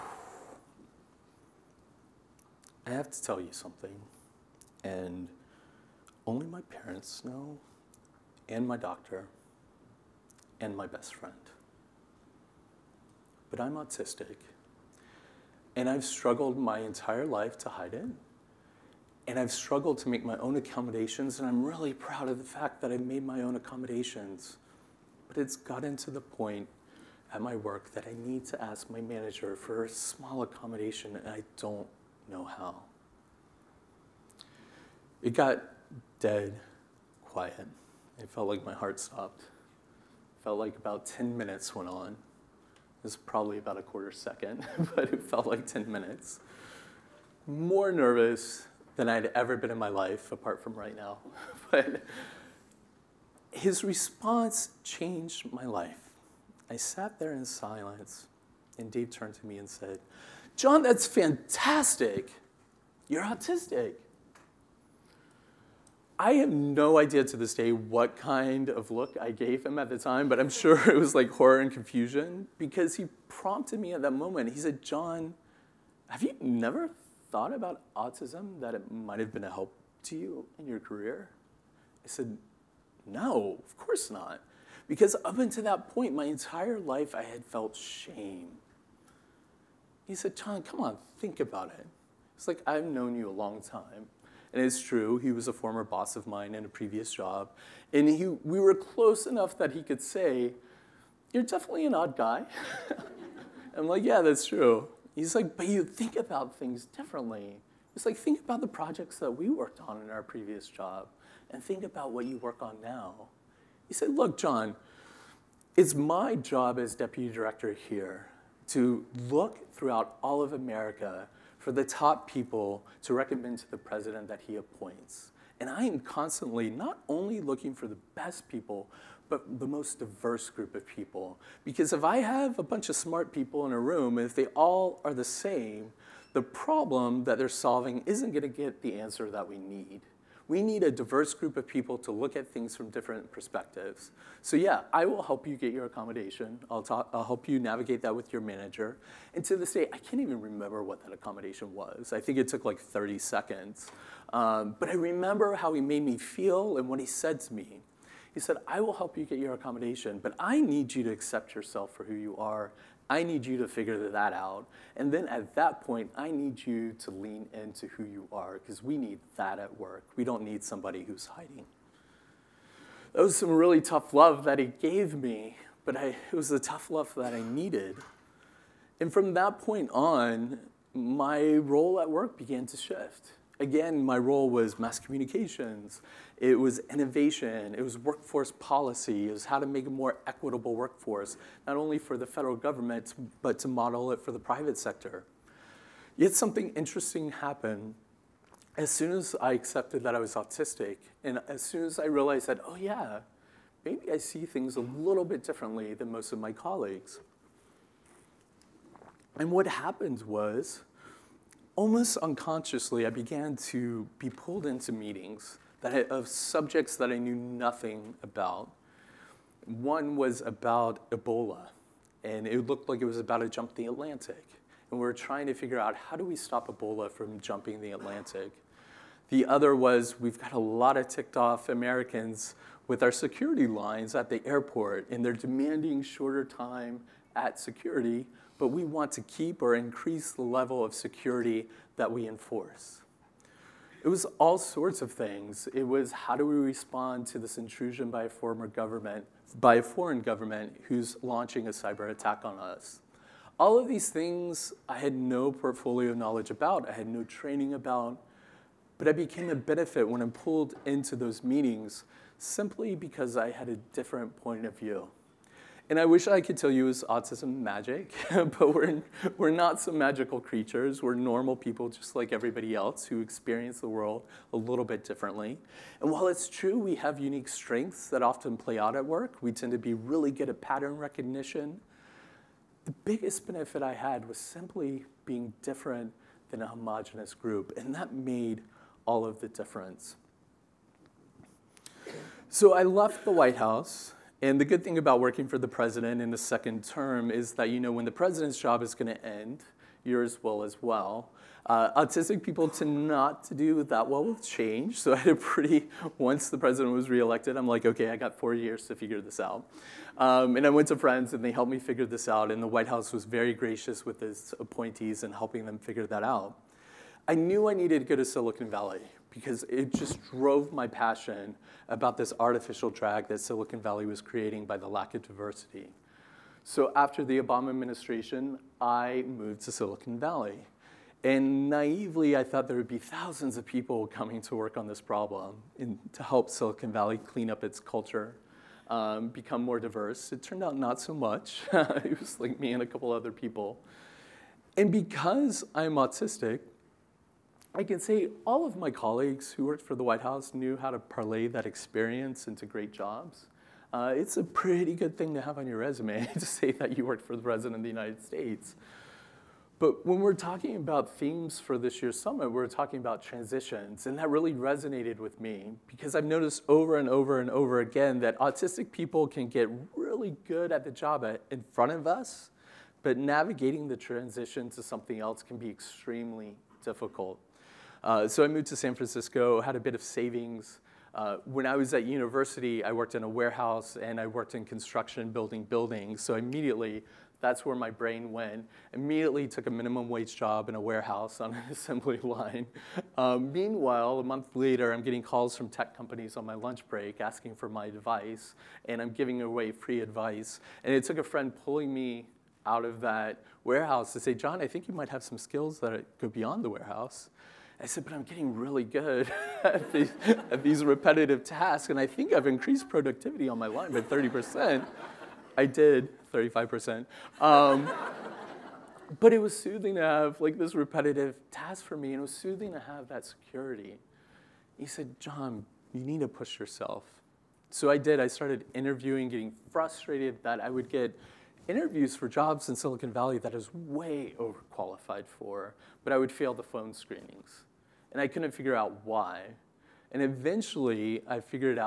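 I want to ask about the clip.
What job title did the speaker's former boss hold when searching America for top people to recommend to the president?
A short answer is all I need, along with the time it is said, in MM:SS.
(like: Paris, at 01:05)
Deputy director, at 01:56.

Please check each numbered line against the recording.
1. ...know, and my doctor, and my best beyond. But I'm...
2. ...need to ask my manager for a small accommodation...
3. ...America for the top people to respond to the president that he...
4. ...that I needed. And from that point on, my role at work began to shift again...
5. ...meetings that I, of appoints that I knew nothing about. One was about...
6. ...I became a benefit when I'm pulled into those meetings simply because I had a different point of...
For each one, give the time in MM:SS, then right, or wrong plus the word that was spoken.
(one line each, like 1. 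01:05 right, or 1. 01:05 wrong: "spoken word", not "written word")
1. 00:07 wrong: "friend", not "beyond"
2. 00:28 right
3. 02:00 wrong: "recommend", not "respond"
4. 02:57 right
5. 03:34 wrong: "subjects", not "appoints"
6. 04:19 right.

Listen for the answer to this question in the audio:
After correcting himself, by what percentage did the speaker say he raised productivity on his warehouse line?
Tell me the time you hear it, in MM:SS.
06:56.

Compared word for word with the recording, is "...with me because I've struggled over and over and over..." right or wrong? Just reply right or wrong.
wrong.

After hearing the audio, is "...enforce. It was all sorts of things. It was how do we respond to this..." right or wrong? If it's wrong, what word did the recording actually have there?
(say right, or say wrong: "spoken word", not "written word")
right.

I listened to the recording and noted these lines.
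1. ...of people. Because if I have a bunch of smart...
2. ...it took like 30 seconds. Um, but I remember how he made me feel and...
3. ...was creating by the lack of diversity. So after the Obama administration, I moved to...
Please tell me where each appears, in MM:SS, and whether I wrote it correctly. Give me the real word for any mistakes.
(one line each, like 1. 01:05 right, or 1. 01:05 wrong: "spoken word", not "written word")
1. 02:10 right
2. 02:32 right
3. 05:24 right.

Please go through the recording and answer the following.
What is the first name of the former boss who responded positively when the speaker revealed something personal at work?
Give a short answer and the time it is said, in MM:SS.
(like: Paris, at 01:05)
Dave, at 00:58.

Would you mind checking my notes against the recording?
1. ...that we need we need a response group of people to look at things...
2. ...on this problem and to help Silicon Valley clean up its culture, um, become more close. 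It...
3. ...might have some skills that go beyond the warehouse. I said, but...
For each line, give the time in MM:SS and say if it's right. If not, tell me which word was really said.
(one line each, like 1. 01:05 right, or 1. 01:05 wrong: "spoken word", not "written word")
1. 02:19 wrong: "diverse", not "response"
2. 05:34 wrong: "diverse", not "close"
3. 06:44 right.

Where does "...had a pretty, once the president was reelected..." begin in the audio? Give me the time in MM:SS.
05:05.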